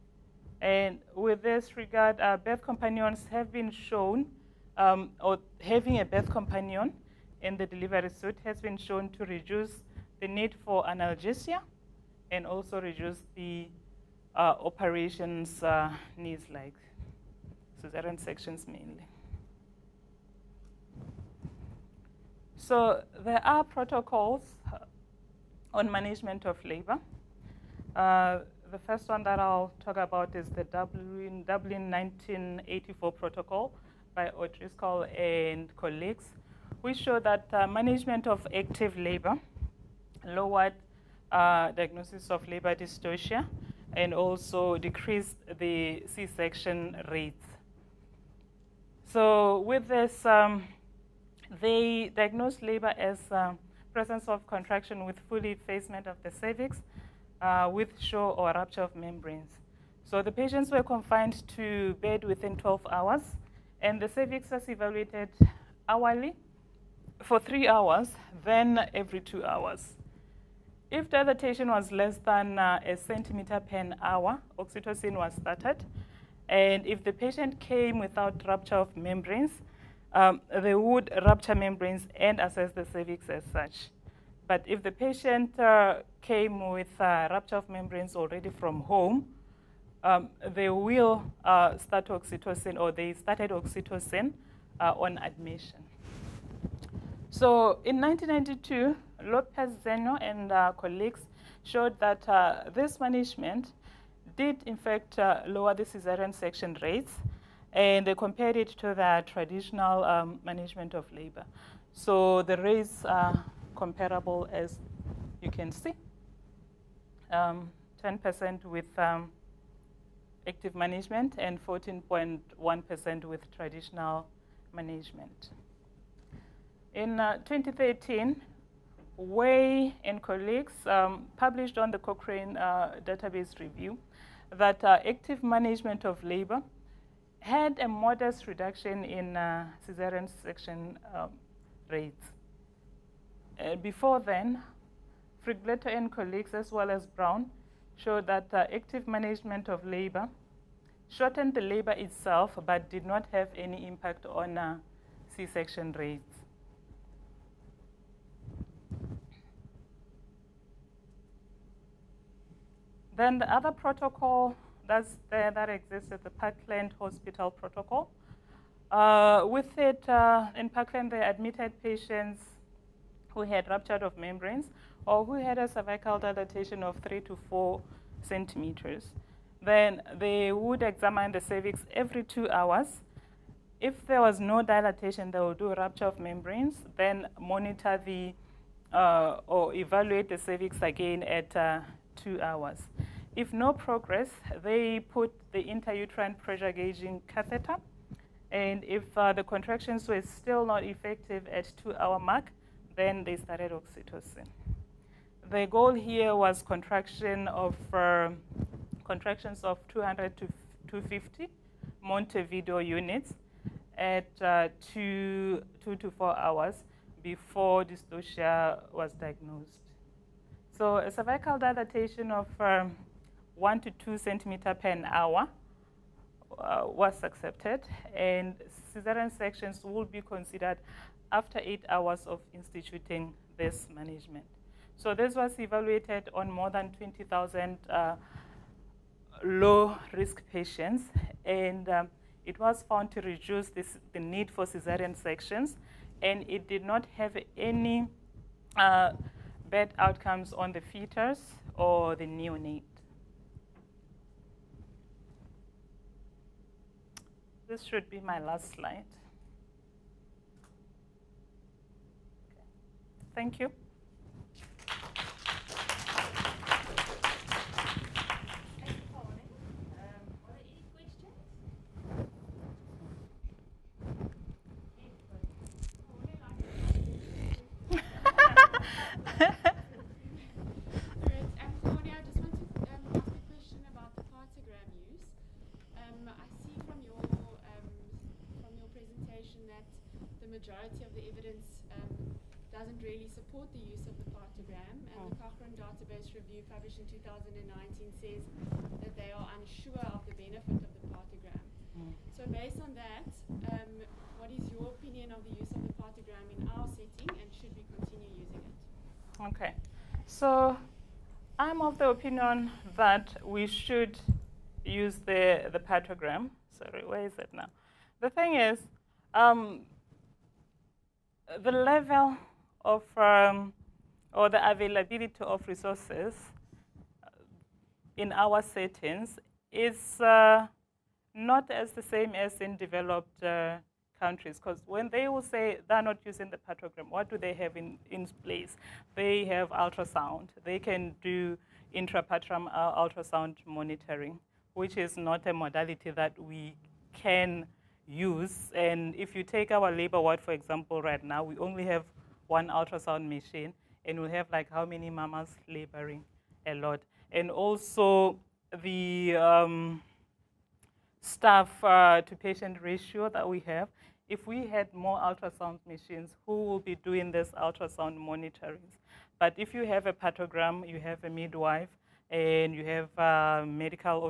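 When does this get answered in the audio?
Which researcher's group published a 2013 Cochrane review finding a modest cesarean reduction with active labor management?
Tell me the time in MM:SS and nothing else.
02:09.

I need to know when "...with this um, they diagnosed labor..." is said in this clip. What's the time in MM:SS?
00:49.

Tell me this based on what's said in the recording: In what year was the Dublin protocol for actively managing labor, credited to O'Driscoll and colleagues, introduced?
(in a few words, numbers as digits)
1984.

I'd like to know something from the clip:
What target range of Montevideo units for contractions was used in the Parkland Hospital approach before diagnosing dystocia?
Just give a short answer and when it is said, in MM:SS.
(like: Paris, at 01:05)
200 to 250, at 03:29.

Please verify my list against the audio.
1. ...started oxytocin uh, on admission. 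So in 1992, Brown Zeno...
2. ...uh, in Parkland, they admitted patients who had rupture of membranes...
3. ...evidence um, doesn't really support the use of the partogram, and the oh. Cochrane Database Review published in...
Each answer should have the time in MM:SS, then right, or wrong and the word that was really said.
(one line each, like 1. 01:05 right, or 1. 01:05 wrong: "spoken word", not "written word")
1. 01:33 wrong: "Lopez", not "Brown"
2. 02:50 right
3. 04:51 right.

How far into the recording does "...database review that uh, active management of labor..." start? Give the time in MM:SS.
02:13.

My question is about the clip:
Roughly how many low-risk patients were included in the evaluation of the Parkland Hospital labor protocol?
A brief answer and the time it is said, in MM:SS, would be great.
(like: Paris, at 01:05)
More than 20,000, at 03:56.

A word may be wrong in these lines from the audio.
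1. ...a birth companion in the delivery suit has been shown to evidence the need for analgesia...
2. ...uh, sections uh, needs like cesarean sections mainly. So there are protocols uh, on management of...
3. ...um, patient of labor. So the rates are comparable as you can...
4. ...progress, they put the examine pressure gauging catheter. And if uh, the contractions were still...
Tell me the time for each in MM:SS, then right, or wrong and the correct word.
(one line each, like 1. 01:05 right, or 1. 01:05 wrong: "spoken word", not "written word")
1. 00:05 wrong: "reduce", not "evidence"
2. 00:14 wrong: "operations", not "sections"
3. 01:50 wrong: "management", not "patient"
4. 03:13 wrong: "intrauterine", not "examine".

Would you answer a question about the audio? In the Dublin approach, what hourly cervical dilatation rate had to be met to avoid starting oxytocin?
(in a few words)
1 centimeter per hour.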